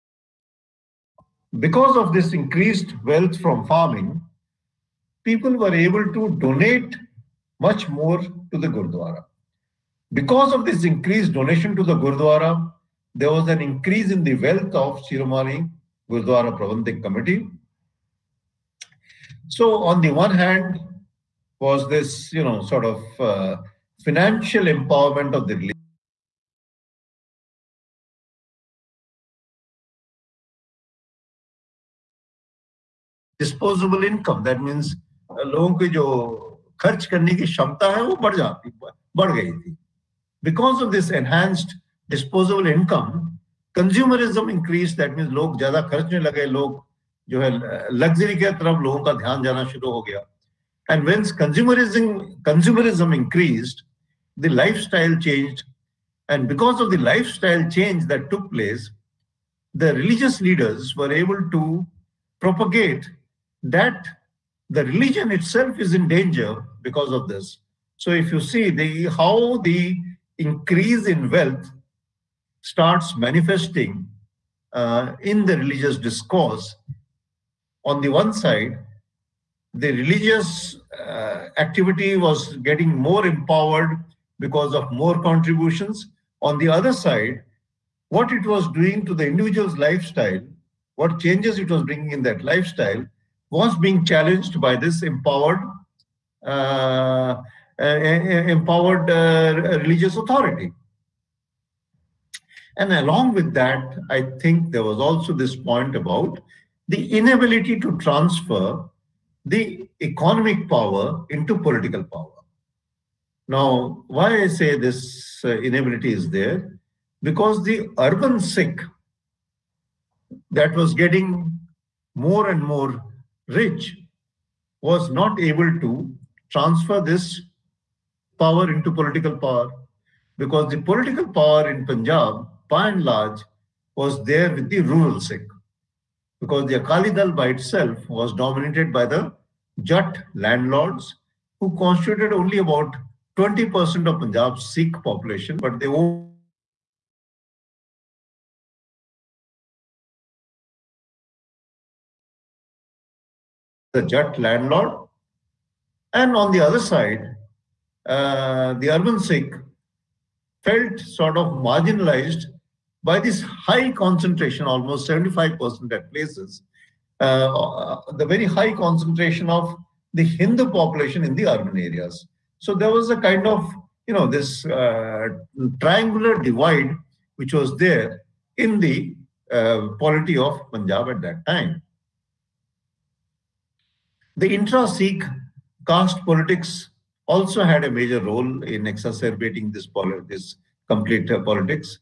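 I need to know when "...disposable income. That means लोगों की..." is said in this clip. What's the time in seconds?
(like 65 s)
33 s.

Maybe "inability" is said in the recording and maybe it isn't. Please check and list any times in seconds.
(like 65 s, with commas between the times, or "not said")
107 s, 115 s.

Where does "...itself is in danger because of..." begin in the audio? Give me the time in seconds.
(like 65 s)
65 s.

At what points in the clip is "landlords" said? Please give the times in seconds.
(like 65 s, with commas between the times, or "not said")
140 s, 154 s.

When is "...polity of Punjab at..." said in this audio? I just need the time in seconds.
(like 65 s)
179 s.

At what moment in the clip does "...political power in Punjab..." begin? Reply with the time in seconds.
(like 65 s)
130 s.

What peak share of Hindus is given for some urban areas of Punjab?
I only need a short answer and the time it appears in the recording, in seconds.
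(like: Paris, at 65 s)
75%, at 165 s.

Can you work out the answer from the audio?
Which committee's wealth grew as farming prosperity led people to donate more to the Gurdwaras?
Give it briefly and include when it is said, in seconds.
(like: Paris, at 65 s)
Shiromani Gurdwara Prabandhak Committee, at 15 s.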